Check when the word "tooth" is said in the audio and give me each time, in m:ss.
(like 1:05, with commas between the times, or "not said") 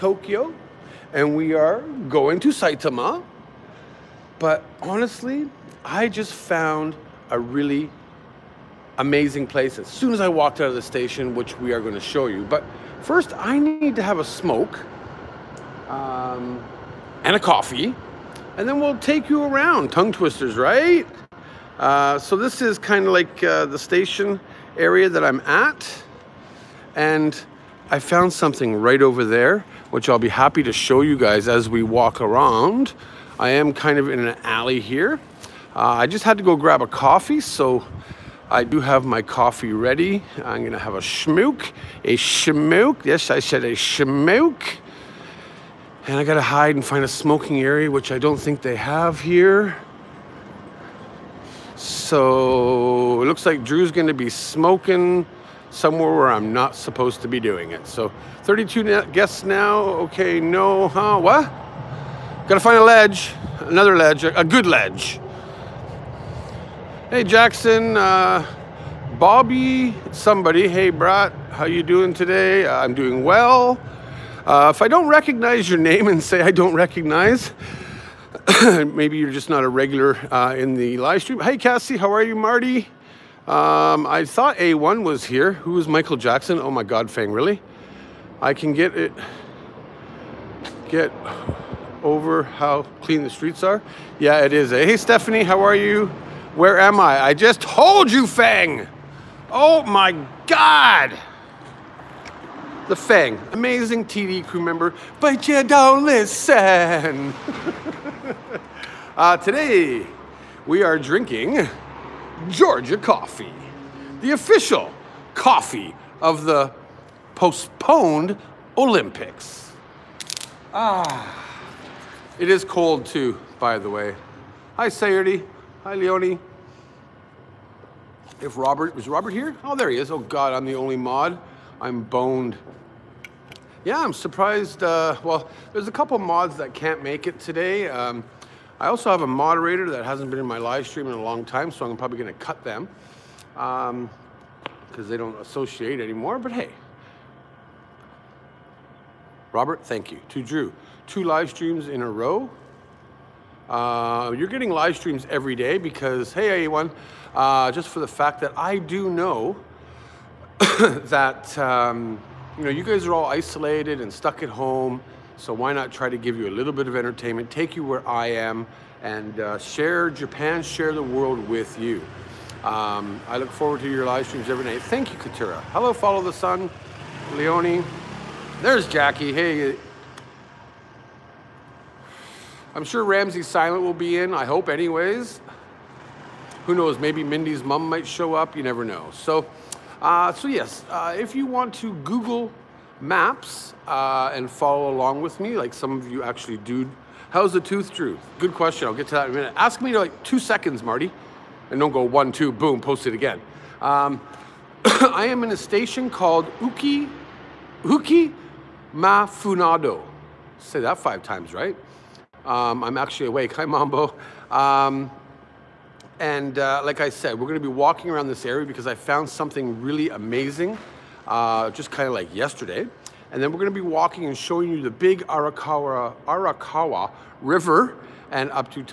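3:17.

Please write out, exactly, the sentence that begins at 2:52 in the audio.
Um, I look forward to your live streams every night.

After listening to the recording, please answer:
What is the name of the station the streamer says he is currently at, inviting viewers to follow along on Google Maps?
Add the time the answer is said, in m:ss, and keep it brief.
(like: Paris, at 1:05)
Uki Mafunado, at 3:27.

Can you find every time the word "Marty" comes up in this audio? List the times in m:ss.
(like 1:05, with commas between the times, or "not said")
1:22, 3:20.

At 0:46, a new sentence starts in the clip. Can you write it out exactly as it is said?
And I gotta hide and find a smoking area, which I don't think they have here.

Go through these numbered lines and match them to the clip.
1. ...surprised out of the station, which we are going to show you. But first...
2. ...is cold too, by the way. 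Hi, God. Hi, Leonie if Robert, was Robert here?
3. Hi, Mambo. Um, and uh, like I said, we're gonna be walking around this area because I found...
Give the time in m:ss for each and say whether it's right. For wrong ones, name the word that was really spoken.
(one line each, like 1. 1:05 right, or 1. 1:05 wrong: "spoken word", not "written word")
1. 0:10 wrong: "walked", not "surprised"
2. 2:02 wrong: "Sayerty", not "God"
3. 3:33 right.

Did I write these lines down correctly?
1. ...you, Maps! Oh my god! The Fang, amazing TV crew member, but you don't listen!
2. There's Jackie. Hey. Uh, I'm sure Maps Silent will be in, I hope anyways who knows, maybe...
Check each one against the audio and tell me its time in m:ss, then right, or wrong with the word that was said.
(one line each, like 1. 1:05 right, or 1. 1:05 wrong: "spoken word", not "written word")
1. 1:38 wrong: "Fang", not "Maps"
2. 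2:58 wrong: "Ramses", not "Maps".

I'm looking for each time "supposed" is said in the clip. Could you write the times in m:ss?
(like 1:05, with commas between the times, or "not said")
0:56.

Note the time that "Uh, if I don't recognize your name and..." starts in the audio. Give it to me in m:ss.
1:14.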